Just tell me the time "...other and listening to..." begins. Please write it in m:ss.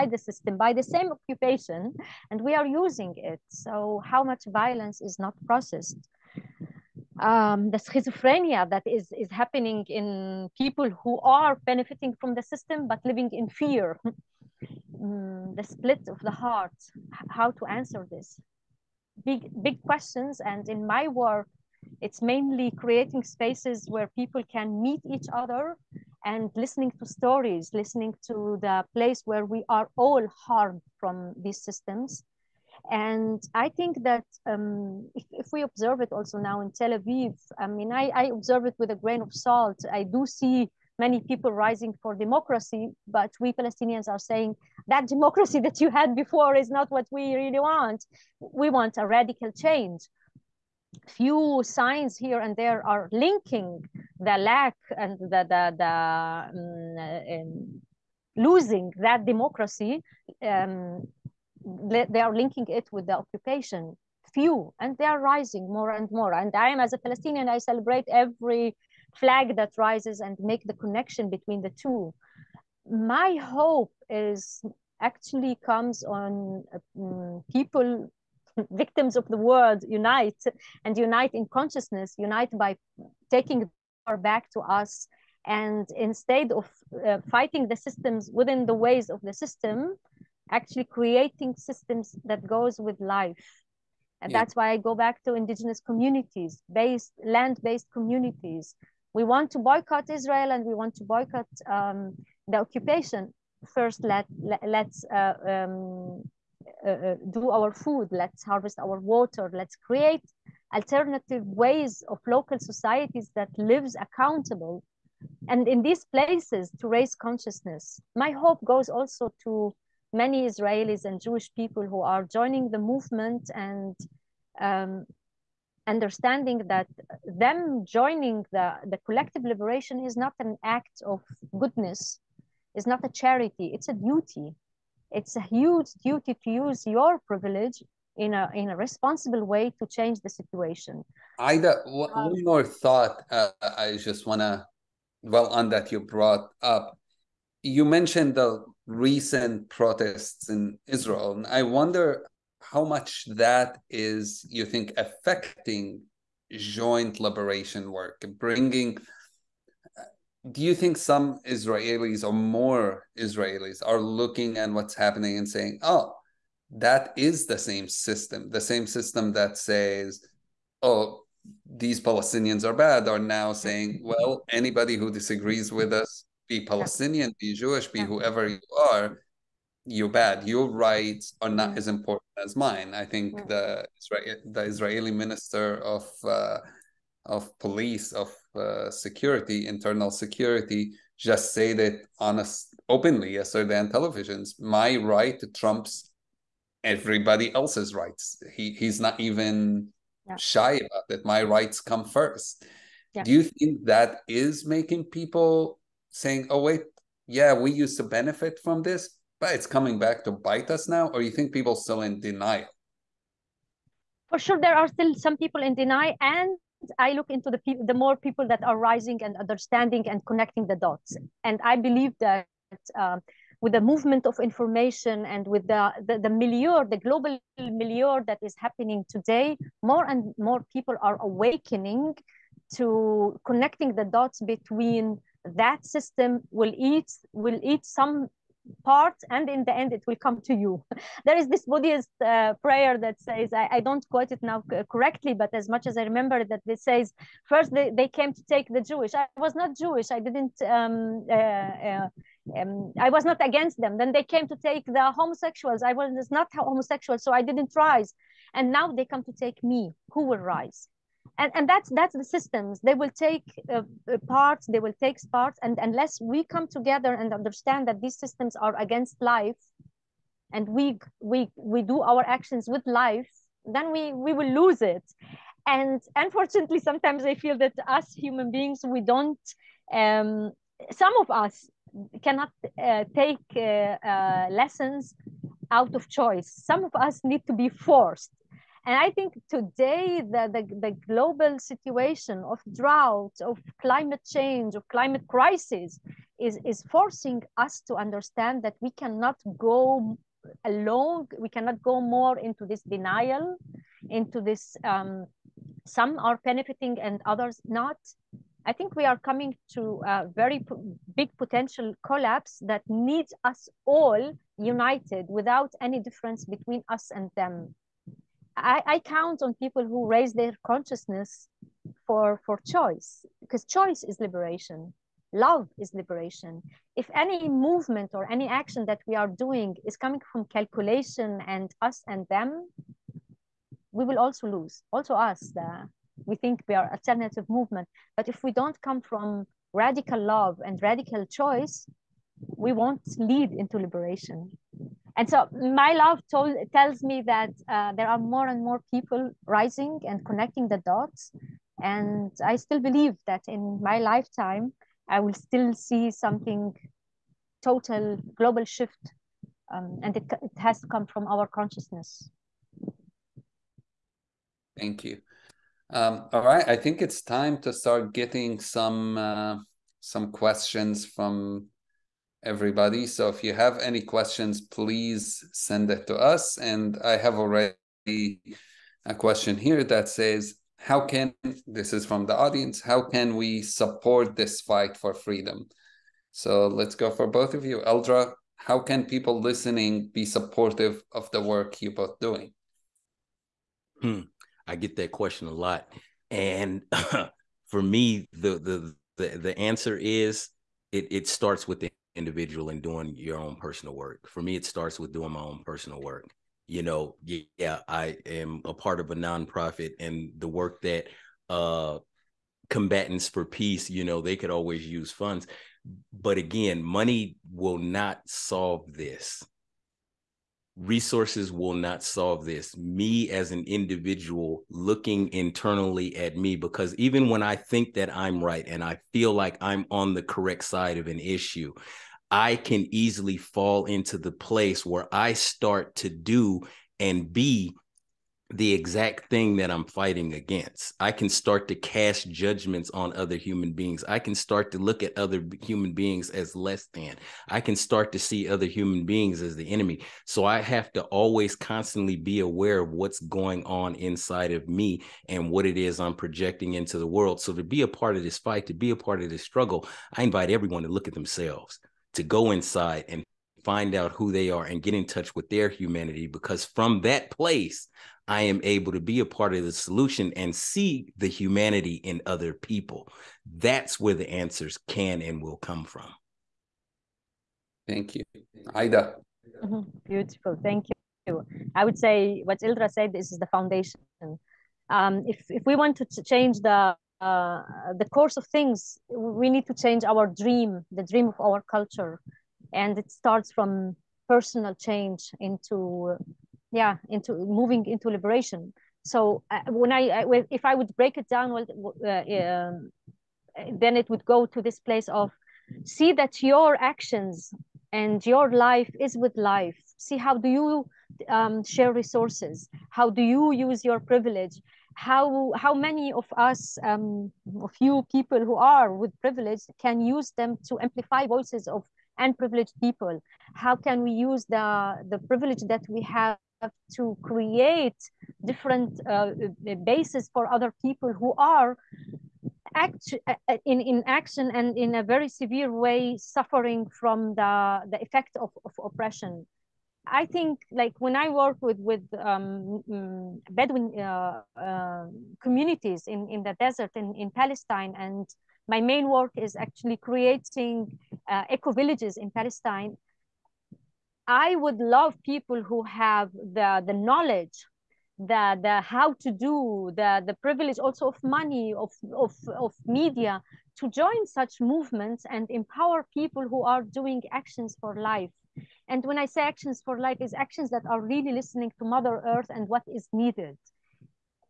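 0:25.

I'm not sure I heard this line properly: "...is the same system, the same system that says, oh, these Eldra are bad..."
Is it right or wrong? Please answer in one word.
wrong.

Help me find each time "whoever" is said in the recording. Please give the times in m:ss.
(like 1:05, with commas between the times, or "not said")
2:58.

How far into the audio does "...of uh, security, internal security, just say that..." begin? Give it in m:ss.
3:08.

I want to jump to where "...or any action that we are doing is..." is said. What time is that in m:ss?
5:28.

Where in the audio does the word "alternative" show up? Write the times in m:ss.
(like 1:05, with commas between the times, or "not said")
1:50, 5:36.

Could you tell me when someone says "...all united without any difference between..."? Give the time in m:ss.
5:13.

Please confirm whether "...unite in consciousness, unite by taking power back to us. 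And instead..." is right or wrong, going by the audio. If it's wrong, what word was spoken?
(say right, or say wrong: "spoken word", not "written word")
right.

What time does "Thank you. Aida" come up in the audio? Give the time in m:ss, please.
7:57.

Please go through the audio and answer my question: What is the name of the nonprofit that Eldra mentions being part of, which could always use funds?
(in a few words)
Combatants for Peace.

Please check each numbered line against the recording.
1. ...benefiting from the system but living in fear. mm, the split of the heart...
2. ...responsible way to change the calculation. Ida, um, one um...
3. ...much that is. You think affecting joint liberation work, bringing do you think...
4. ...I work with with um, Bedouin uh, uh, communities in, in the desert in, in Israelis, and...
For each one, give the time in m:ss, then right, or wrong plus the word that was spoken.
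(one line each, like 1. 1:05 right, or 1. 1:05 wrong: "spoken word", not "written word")
1. 0:11 right
2. 2:18 wrong: "situation", not "calculation"
3. 2:32 right
4. 9:01 wrong: "Palestine", not "Israelis".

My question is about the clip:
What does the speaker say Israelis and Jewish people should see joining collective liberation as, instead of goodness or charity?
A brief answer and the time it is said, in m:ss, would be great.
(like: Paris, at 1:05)
A duty, at 2:13.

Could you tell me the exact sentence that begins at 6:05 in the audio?
Um, all right, I think it's time to start getting some uh, some questions from everybody.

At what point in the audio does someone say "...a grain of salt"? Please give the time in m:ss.
0:38.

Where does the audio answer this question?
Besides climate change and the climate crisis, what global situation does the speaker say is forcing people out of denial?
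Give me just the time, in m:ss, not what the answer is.
4:52.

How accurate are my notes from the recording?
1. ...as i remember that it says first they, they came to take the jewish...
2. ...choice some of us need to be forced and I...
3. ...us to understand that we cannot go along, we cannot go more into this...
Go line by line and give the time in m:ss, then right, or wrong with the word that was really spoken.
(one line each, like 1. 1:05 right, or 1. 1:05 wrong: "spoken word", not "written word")
1. 4:05 right
2. 4:46 right
3. 4:57 right.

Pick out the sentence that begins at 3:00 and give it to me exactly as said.
Your rights are not as important as mine.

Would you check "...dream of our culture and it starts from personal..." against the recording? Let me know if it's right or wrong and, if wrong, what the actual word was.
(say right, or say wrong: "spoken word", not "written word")
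right.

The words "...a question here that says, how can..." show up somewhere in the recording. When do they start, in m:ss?
6:19.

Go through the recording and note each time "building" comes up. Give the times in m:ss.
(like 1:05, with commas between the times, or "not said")
not said.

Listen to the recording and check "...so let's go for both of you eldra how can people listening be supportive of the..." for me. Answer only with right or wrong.
right.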